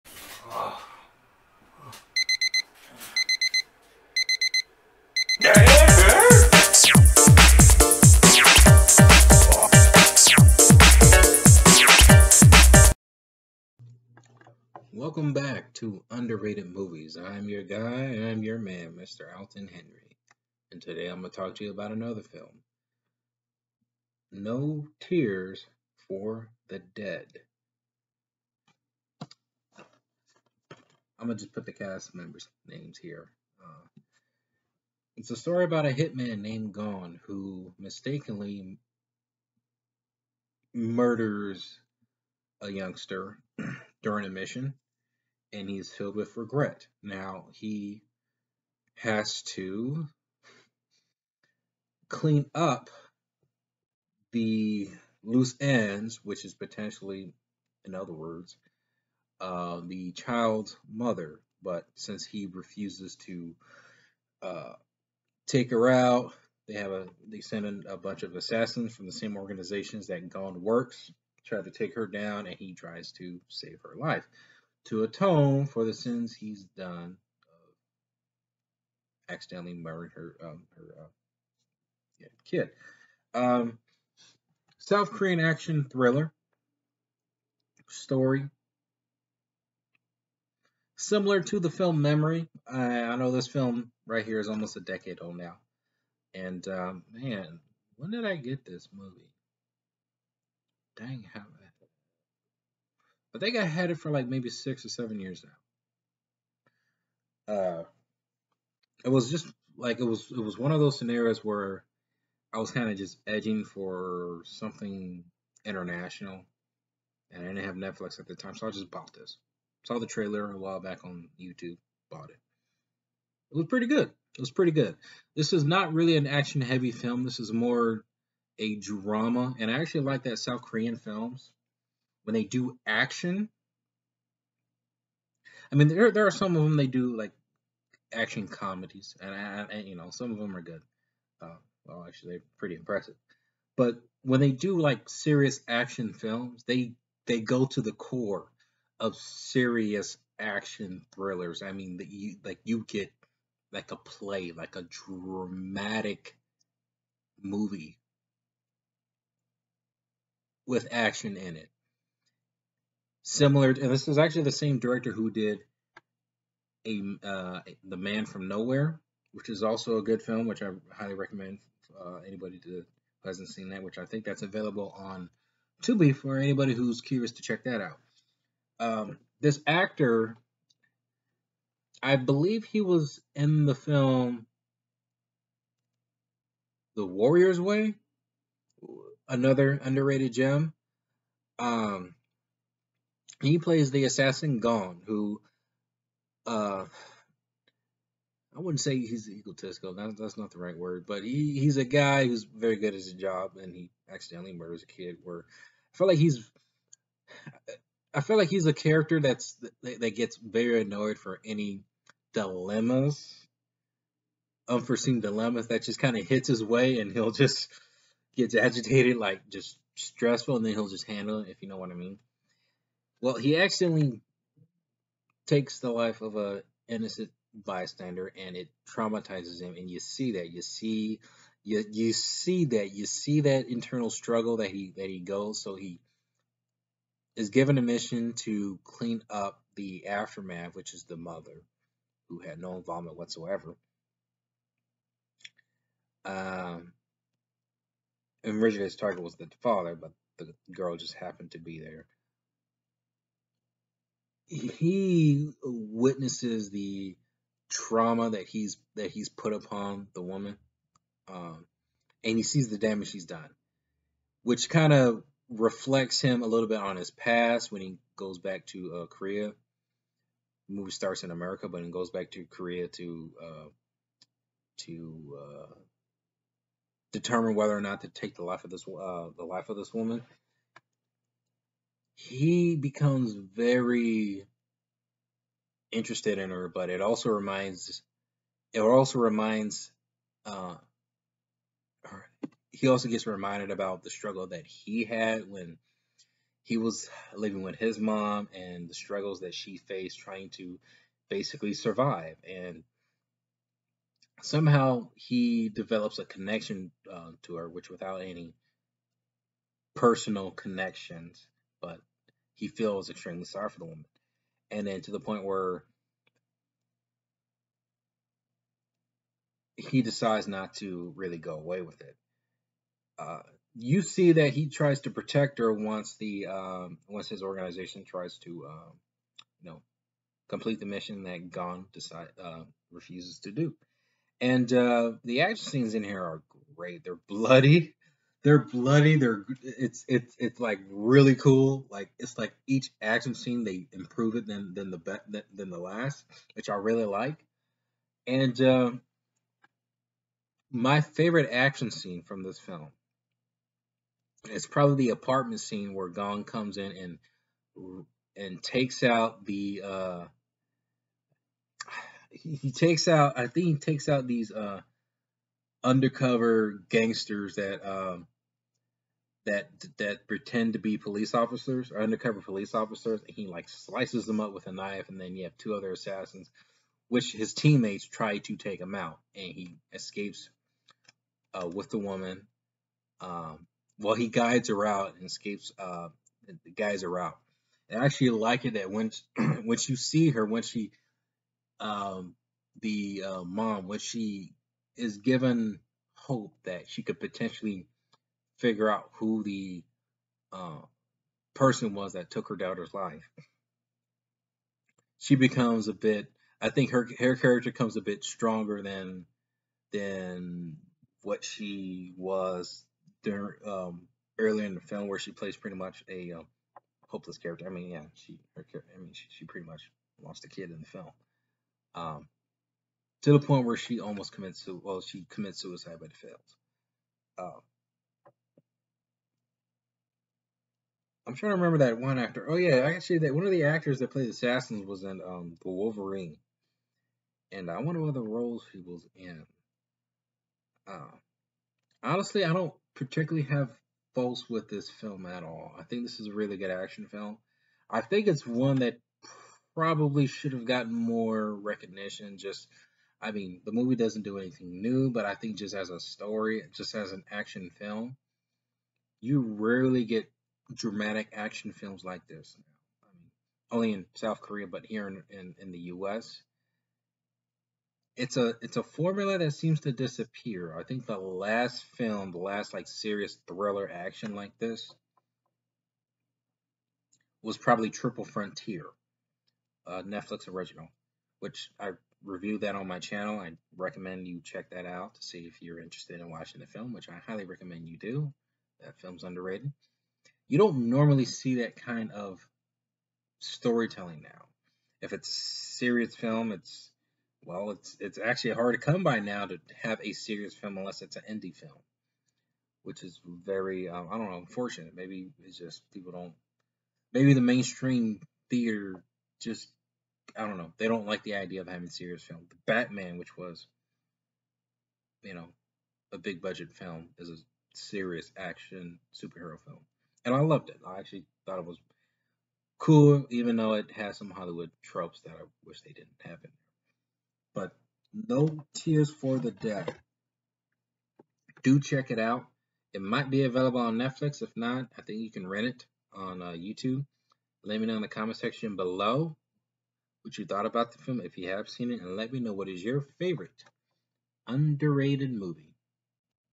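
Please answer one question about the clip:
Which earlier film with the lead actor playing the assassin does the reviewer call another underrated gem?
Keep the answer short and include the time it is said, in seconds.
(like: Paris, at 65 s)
The Warrior's Way, at 186 s.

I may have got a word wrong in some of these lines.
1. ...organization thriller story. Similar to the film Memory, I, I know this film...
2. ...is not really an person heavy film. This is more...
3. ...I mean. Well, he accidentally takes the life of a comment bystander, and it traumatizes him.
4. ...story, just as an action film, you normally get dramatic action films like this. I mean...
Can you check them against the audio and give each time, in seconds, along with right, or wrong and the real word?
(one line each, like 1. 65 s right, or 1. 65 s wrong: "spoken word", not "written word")
1. 85 s wrong: "action", not "organization"
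2. 125 s wrong: "action", not "person"
3. 221 s wrong: "innocent", not "comment"
4. 455 s wrong: "rarely", not "normally".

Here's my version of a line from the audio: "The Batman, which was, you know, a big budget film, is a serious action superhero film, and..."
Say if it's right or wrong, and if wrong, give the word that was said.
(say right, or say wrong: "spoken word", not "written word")
right.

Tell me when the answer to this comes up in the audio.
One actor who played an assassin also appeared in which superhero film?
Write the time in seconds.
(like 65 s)
435 s.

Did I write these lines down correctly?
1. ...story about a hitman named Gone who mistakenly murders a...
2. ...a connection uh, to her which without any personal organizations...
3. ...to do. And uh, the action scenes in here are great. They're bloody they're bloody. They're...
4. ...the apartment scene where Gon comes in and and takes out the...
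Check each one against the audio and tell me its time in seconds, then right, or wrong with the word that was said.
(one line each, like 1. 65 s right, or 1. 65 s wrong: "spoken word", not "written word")
1. 35 s right
2. 306 s wrong: "connections", not "organizations"
3. 333 s right
4. 355 s right.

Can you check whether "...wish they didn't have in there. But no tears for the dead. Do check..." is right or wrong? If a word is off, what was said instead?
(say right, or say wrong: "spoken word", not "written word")
right.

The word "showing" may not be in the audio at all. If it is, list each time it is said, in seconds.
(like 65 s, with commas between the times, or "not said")
not said.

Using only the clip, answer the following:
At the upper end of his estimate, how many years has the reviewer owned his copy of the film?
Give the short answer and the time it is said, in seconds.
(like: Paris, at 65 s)
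7, at 104 s.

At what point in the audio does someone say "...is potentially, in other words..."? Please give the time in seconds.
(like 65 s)
56 s.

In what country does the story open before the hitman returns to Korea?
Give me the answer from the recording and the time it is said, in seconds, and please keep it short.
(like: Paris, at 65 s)
America, at 271 s.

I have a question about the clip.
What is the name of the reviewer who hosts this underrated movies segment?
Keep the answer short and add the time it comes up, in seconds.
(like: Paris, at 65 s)
Alton Henry, at 19 s.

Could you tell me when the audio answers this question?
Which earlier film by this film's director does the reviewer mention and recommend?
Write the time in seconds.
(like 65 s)
167 s.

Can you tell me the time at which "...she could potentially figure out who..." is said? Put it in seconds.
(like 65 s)
396 s.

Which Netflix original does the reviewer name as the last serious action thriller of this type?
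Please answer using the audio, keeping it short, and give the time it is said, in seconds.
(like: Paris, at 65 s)
Triple Frontier, at 477 s.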